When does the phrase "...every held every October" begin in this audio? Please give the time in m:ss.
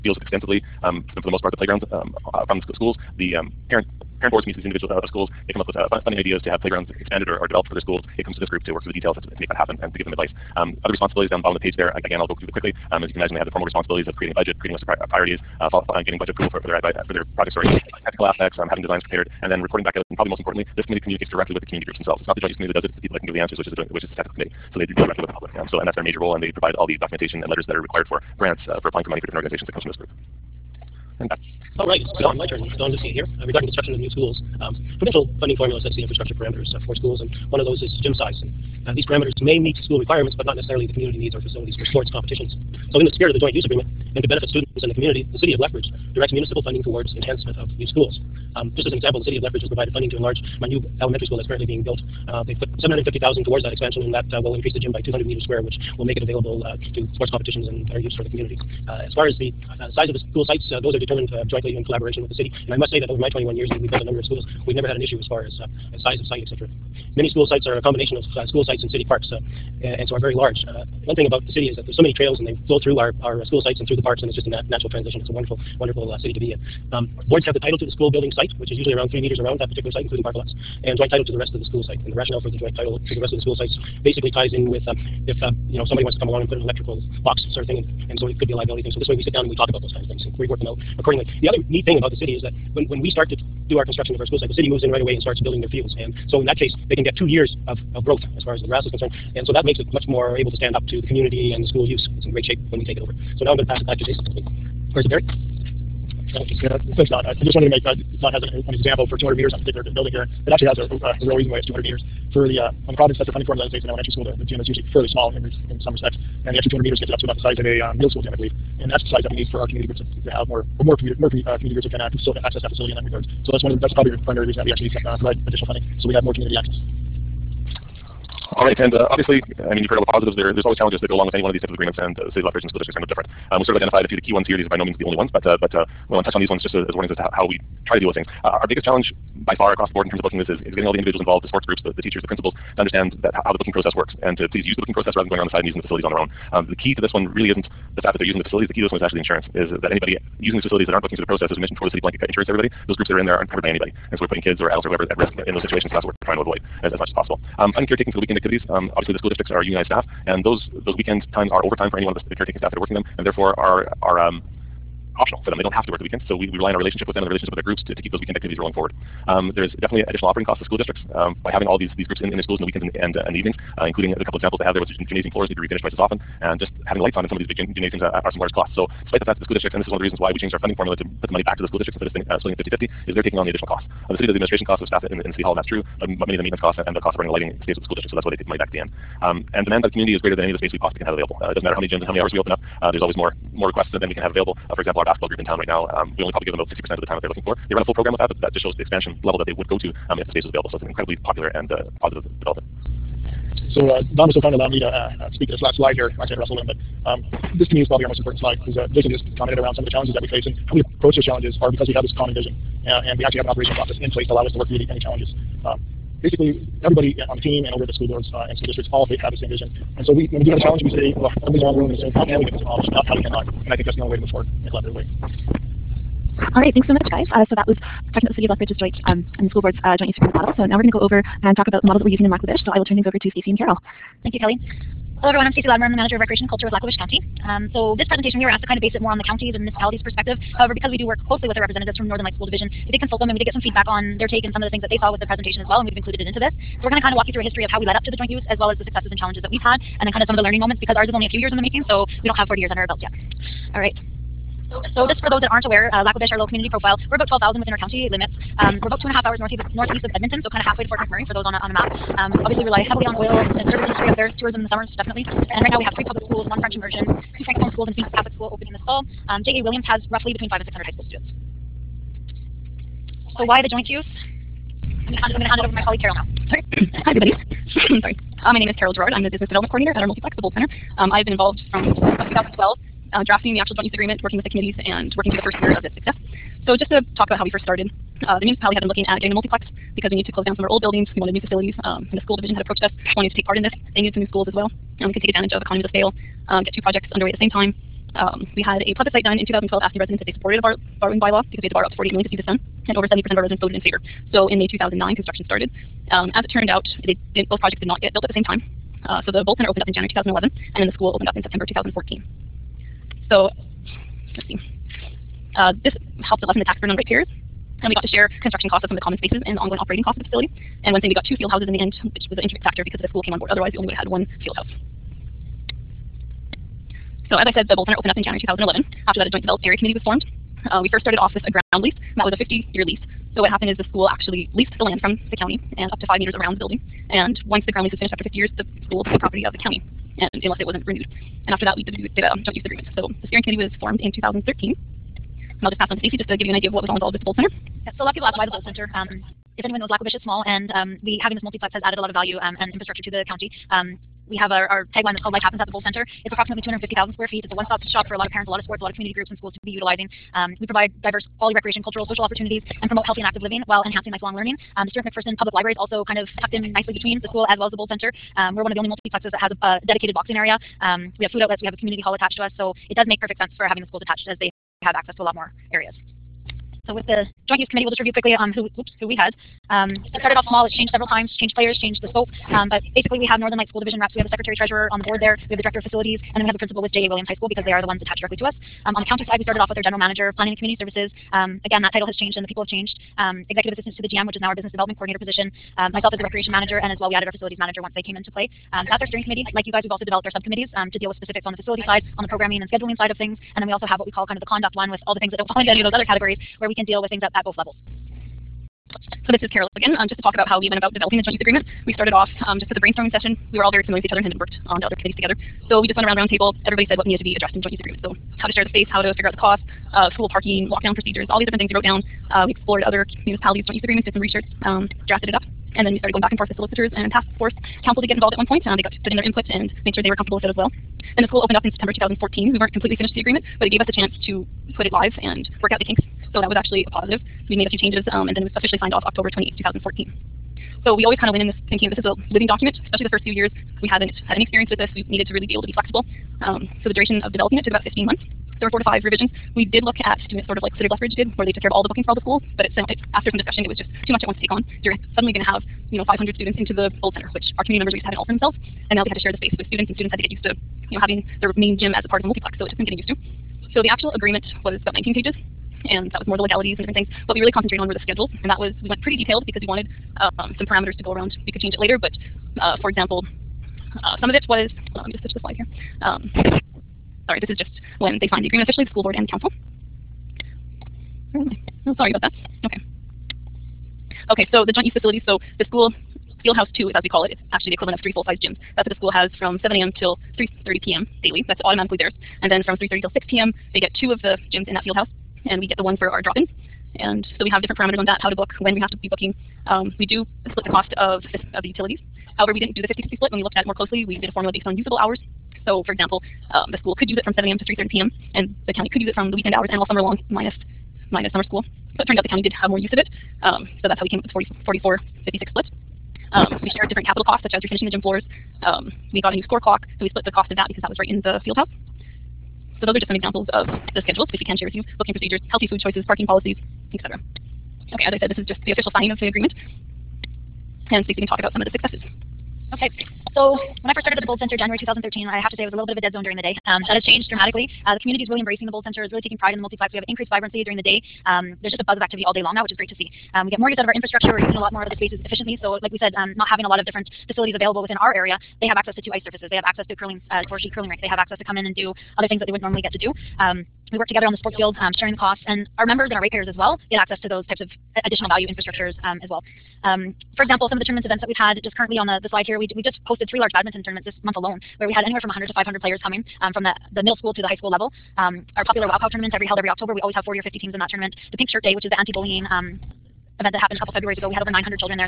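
9:29.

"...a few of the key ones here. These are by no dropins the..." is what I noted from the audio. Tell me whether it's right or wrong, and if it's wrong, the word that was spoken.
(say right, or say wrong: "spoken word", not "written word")
wrong: "means", not "dropins".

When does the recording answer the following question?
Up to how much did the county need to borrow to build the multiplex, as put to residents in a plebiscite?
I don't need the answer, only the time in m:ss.
5:01.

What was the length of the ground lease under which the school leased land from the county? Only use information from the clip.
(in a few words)
50 years.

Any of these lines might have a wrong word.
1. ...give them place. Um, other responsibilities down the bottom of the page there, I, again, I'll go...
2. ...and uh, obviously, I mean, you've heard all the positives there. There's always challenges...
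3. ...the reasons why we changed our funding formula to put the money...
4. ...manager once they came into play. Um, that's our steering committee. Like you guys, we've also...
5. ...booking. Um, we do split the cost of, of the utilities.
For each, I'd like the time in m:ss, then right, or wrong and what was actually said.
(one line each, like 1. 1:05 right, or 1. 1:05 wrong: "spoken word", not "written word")
1. 0:09 wrong: "advice", not "place"
2. 2:08 right
3. 2:59 right
4. 6:37 right
5. 8:19 right.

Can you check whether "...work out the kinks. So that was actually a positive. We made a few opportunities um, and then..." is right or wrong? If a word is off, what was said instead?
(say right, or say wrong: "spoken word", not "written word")
wrong: "changes", not "opportunities".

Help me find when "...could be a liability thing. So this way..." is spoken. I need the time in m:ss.
1:28.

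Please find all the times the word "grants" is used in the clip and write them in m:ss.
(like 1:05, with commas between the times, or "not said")
0:28.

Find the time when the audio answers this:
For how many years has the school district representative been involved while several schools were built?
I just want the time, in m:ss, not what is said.
1:03.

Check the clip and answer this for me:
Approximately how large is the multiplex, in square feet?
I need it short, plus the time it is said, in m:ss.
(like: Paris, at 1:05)
250,000 square feet, at 5:56.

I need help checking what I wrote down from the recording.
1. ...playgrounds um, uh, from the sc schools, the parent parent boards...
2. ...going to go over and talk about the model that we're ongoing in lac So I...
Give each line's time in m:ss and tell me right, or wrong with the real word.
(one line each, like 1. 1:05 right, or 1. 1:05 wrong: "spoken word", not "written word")
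1. 0:01 right
2. 3:50 wrong: "using", not "ongoing".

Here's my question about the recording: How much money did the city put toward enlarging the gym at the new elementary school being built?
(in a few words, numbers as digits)
$750,000.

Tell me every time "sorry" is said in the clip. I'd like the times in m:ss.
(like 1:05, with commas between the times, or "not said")
0:17, 4:38, 7:57, 8:01.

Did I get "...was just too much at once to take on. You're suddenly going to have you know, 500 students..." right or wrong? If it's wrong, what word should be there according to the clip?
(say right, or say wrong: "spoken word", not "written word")
right.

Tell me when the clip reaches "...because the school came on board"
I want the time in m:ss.
5:22.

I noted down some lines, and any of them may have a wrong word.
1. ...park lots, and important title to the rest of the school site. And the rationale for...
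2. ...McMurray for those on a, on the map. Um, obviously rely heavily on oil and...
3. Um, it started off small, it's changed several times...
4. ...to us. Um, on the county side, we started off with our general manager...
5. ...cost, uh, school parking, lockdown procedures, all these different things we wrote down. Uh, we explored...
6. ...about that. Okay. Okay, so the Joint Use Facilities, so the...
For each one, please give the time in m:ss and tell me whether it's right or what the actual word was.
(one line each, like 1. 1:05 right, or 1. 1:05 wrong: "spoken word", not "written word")
1. 1:20 wrong: "joint", not "important"
2. 4:20 right
3. 6:19 right
4. 6:28 right
5. 6:59 right
6. 8:02 right.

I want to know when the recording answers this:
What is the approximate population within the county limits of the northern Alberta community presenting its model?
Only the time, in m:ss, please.
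4:17.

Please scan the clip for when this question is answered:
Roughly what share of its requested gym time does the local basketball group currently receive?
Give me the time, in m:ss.
3:16.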